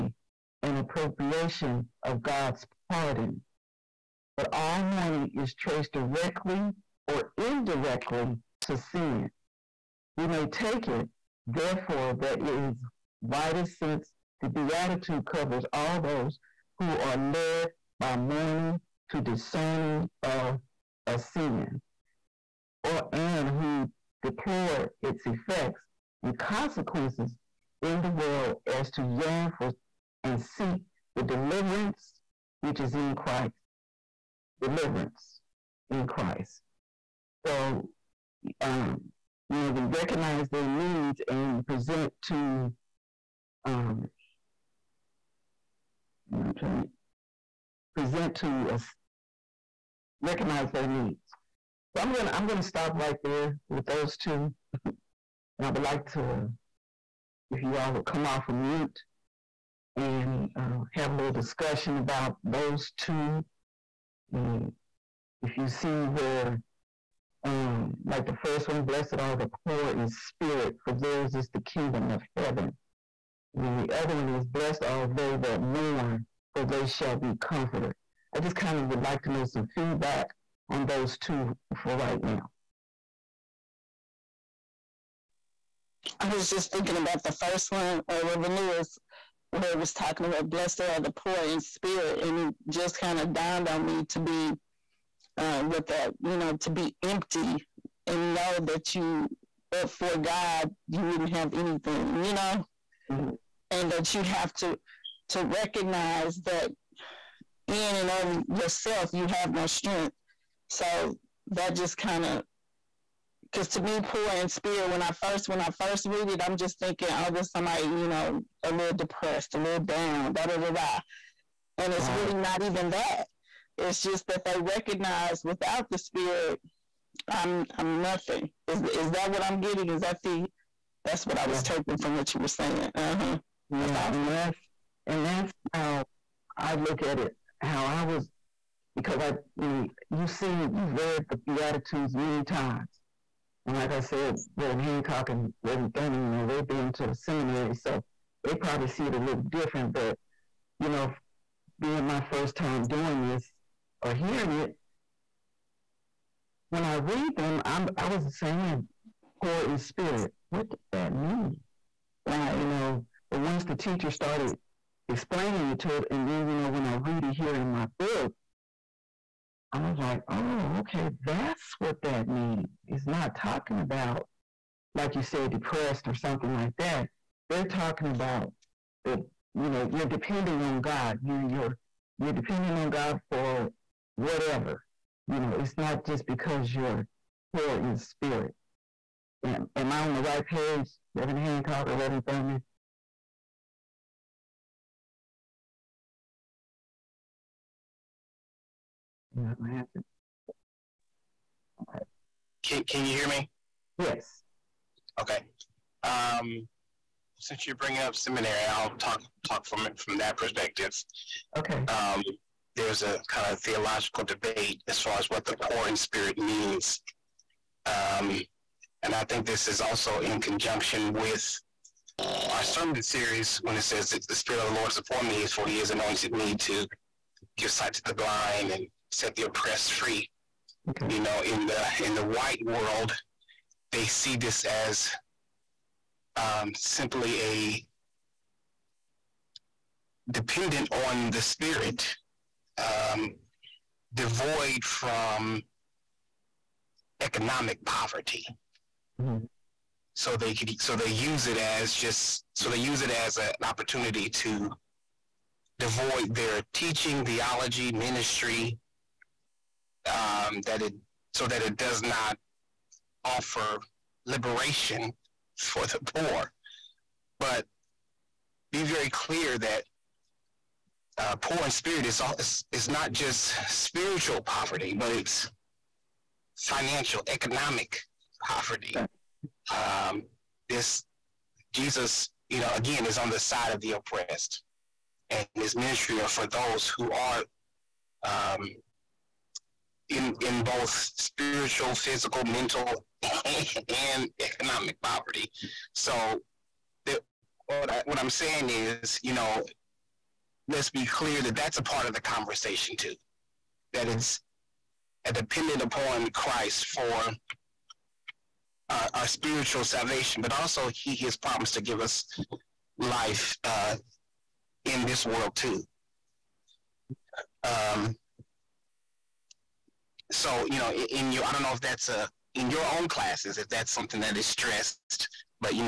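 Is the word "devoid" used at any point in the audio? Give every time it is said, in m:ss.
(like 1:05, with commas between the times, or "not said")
4:04, 4:15.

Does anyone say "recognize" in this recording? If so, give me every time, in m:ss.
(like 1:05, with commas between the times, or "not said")
0:39, 0:50, 1:45, 2:04.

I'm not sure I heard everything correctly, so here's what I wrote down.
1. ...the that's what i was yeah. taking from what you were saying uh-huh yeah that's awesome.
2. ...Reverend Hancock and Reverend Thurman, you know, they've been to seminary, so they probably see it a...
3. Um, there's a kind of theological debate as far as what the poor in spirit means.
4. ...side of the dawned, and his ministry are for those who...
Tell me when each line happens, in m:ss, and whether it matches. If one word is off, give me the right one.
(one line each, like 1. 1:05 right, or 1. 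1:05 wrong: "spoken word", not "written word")
1. 2:10 right
2. 2:24 right
3. 3:31 right
4. 4:43 wrong: "oppressed", not "dawned".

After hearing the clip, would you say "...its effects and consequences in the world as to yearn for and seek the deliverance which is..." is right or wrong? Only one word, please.
right.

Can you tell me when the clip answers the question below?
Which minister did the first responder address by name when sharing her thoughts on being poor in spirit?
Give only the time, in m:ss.
1:28.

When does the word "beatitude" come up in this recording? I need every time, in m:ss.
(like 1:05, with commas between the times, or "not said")
0:14, 2:21.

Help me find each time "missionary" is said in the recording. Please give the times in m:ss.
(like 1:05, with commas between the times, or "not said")
not said.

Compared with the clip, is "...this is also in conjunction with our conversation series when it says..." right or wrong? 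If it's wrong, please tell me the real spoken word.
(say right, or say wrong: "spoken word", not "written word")
wrong: "sermon", not "conversation".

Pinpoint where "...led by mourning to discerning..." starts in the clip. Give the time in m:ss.
0:17.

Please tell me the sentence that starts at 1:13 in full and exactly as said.
And then the other one is, blessed are they that mourn, for they shall be comforted.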